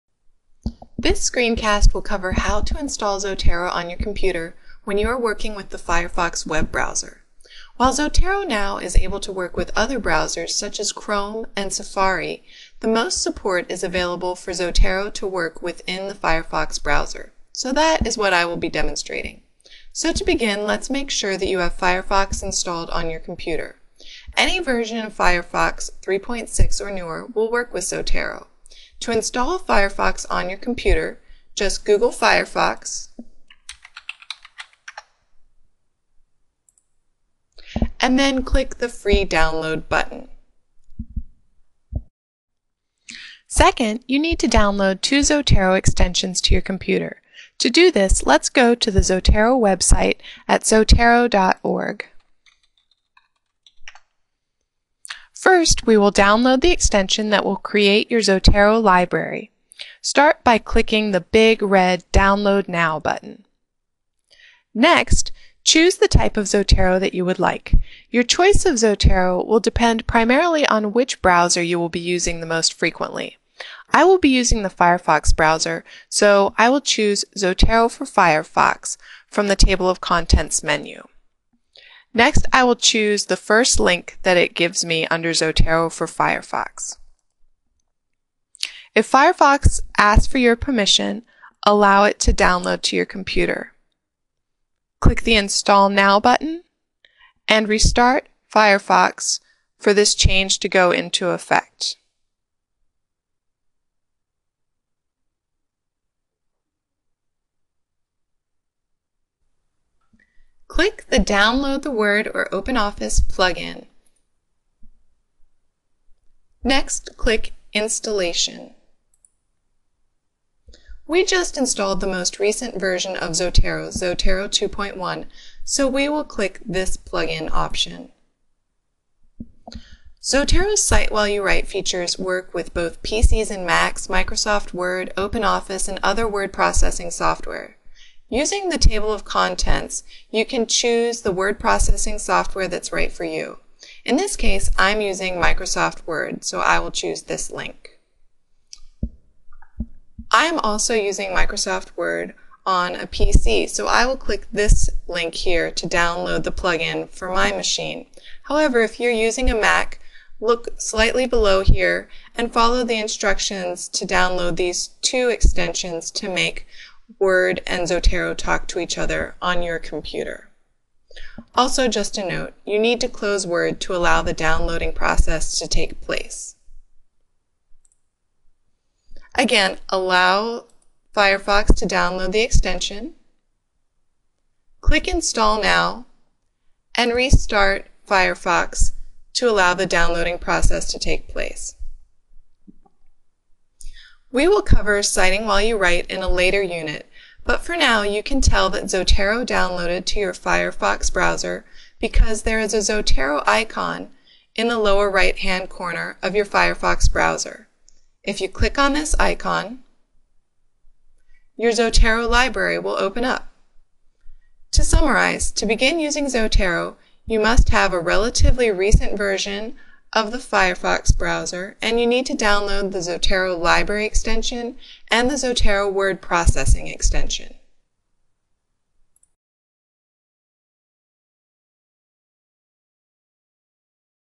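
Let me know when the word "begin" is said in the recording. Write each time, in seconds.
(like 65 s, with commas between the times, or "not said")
20 s, 215 s.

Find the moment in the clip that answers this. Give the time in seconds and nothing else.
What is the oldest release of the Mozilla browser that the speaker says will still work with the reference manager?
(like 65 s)
26 s.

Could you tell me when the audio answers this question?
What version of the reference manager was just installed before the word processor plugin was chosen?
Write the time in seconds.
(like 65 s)
123 s.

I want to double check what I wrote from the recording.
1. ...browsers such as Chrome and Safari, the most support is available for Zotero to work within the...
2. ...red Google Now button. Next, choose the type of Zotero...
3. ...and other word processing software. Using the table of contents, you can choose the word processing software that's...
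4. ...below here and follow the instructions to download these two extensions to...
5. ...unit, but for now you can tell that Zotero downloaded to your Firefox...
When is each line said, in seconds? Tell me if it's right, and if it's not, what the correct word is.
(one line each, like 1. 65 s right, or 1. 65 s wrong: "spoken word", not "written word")
1. 9 s right
2. 61 s wrong: "Download", not "Google"
3. 135 s right
4. 161 s right
5. 196 s right.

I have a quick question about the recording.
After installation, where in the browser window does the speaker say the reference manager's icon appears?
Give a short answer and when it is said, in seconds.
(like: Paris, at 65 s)
lower right-hand corner, at 204 s.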